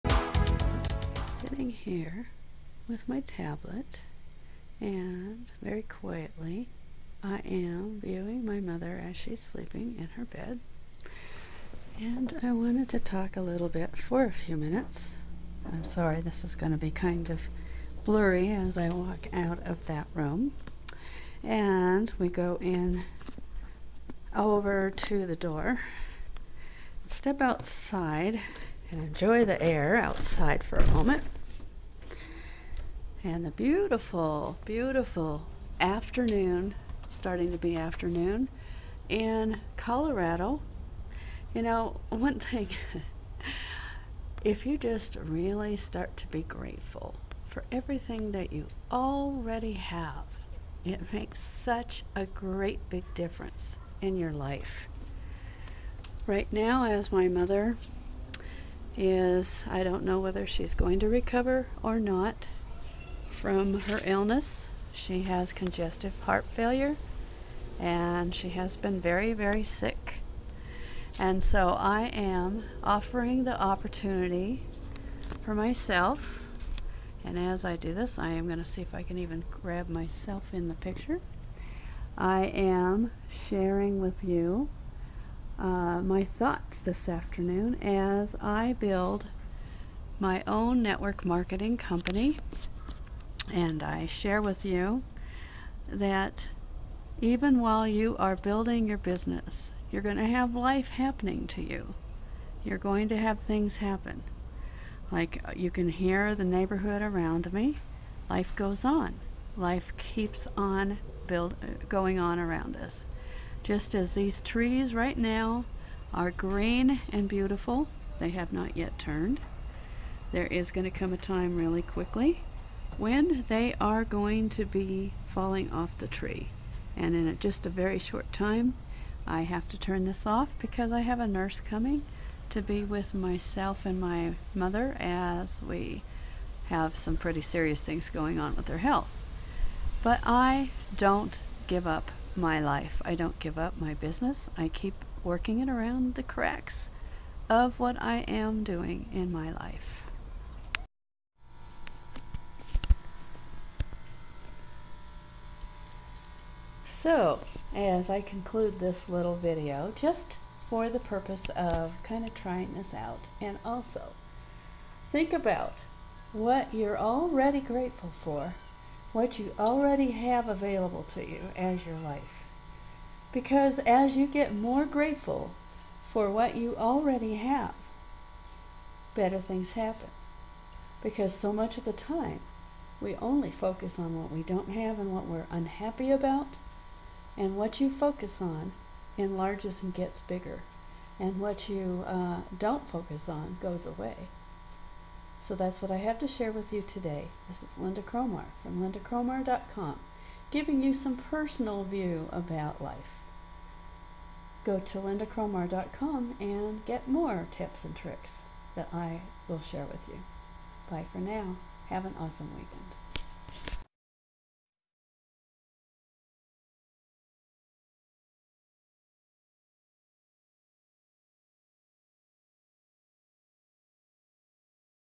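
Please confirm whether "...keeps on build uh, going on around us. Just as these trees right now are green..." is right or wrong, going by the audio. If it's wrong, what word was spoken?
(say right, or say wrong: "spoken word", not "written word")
right.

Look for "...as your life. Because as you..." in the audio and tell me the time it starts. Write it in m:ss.
2:51.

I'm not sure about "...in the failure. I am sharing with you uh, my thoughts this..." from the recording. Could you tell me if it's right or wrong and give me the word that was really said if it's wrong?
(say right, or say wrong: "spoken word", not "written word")
wrong: "picture", not "failure".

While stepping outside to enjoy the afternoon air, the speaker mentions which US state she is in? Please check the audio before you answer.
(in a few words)
Colorado.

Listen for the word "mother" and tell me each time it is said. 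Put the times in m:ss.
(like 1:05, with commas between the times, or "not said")
0:08, 0:57, 2:14.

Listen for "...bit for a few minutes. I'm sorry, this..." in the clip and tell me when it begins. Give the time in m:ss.
0:13.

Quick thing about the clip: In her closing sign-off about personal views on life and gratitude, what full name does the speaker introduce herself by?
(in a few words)
Lynda Cromar.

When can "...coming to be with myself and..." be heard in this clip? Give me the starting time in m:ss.
2:11.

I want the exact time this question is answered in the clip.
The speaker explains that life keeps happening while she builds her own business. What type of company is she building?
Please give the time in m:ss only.
1:30.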